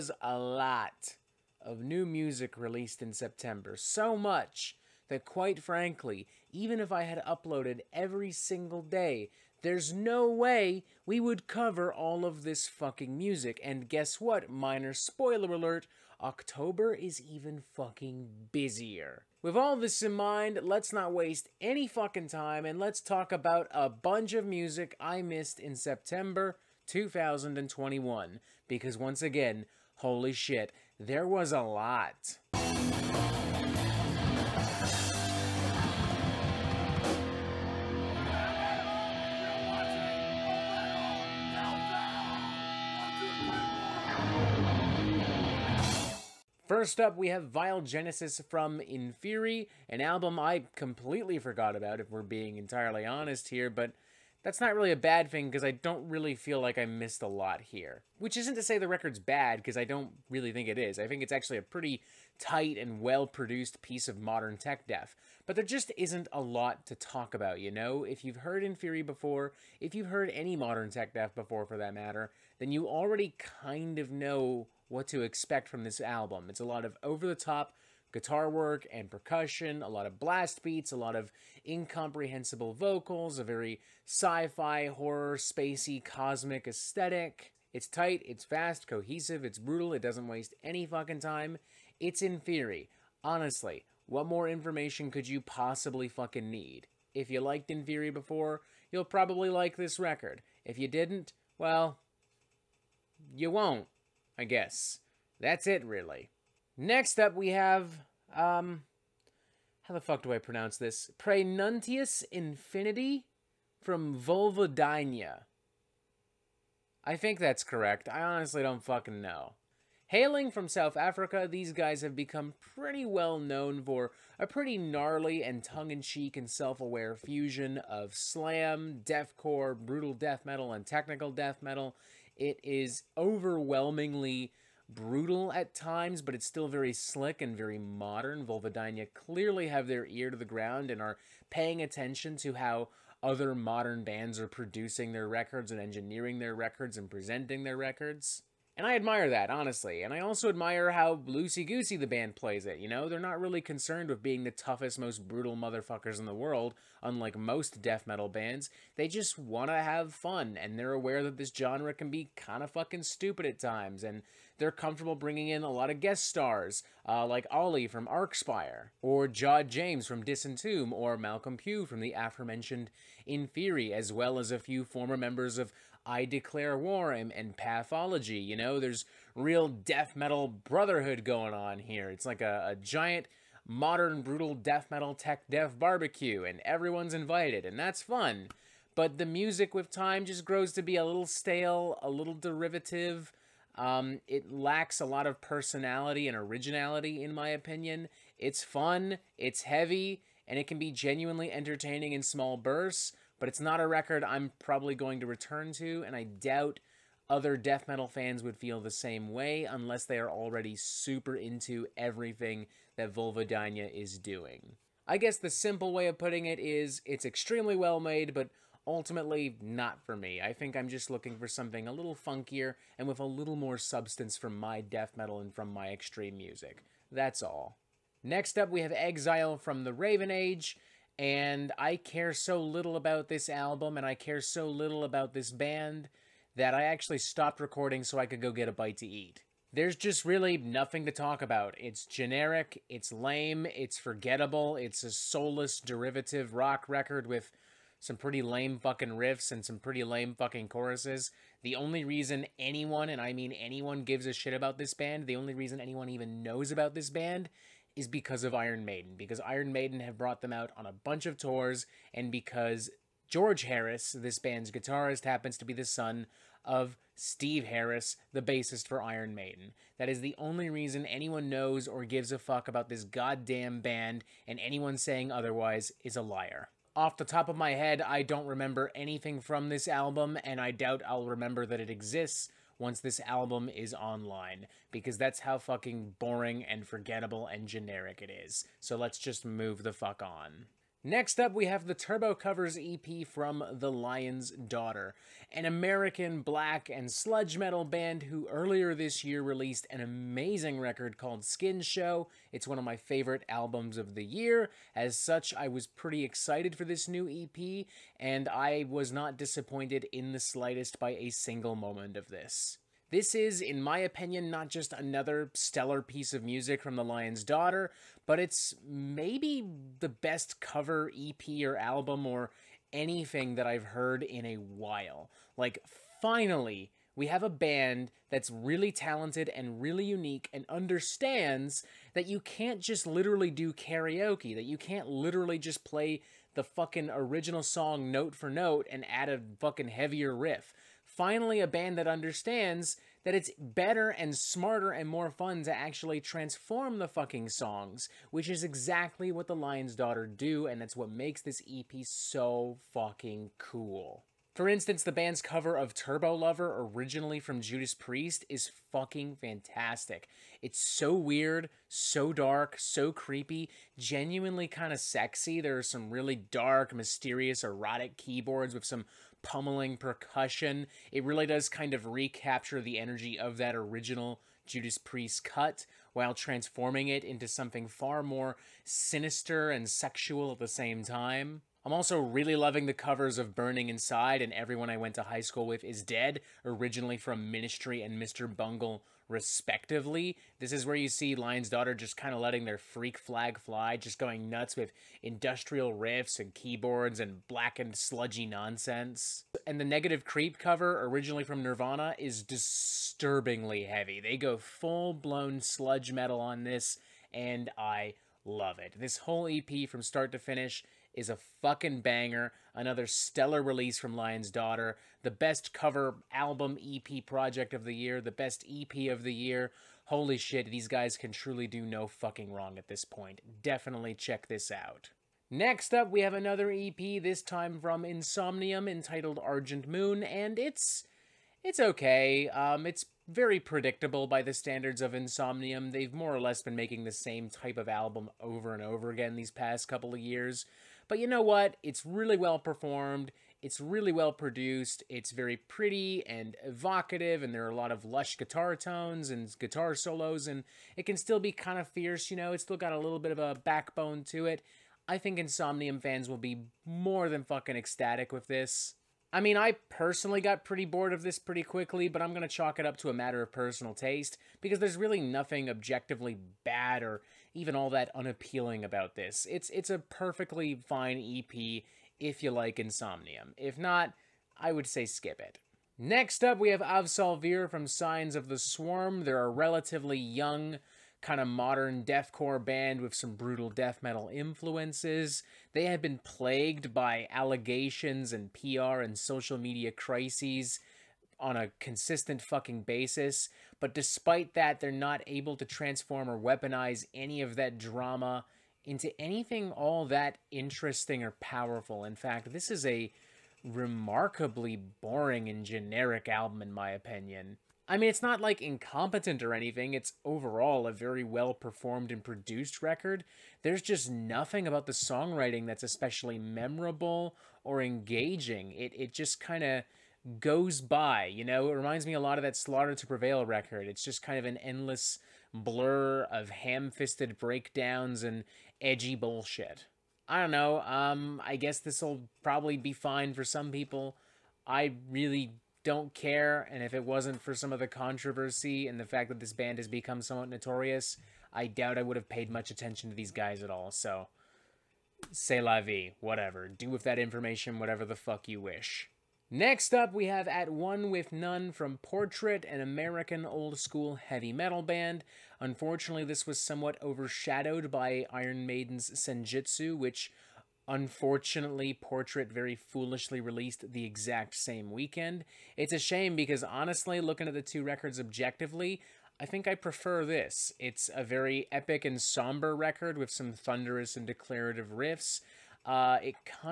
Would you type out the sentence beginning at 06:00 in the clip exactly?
It's so weird, so dark, so creepy, genuinely kind of sexy.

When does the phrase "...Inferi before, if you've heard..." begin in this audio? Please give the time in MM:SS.
01:08.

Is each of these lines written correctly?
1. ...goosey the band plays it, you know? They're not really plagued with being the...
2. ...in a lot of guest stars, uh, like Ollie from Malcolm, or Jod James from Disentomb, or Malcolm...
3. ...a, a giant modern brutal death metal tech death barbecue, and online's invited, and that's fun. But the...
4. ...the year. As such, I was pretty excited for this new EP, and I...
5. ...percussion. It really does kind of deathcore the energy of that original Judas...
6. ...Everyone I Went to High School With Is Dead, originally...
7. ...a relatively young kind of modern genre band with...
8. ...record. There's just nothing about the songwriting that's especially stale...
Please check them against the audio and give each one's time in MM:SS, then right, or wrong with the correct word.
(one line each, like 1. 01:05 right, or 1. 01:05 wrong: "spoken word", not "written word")
1. 02:31 wrong: "concerned", not "plagued"
2. 02:45 wrong: "Archspire", not "Malcolm"
3. 03:02 wrong: "everyone", not "online"
4. 05:04 right
5. 06:09 wrong: "recapture", not "deathcore"
6. 06:24 right
7. 07:59 wrong: "deathcore", not "genre"
8. 08:32 wrong: "memorable", not "stale".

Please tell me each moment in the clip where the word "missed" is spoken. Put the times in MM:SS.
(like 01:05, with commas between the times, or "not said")
00:25, 00:56.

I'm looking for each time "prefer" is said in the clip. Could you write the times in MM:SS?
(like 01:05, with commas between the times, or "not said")
09:29.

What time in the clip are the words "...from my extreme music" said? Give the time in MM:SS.
03:45.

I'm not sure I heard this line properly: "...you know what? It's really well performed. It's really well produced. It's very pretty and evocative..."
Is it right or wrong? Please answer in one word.
right.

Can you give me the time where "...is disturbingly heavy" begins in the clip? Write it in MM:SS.
06:42.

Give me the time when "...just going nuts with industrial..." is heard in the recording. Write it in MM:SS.
06:33.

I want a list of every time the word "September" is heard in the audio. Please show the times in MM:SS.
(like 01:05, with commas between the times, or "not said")
00:03, 00:25.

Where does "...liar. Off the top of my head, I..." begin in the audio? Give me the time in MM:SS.
04:36.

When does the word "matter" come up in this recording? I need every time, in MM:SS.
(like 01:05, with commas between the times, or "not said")
01:11, 07:43.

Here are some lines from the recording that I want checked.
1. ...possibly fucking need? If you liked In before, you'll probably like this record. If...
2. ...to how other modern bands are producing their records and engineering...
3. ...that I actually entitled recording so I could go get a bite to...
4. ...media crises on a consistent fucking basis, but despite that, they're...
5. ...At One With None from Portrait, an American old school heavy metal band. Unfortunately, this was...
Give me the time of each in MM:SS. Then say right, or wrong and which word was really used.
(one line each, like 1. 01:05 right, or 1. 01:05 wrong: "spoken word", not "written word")
1. 01:35 right
2. 02:22 right
3. 03:56 wrong: "stopped", not "entitled"
4. 08:09 right
5. 09:10 right.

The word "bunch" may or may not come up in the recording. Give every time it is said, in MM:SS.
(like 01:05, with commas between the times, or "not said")
00:23, 04:20.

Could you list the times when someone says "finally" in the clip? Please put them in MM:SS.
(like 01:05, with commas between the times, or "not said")
05:26, 05:41.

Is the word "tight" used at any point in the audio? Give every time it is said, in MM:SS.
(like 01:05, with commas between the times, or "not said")
01:02, 01:27.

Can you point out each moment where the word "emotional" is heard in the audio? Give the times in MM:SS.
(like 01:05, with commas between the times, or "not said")
not said.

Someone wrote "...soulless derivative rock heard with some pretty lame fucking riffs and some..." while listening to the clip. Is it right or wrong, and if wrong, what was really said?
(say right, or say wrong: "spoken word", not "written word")
wrong: "record", not "heard".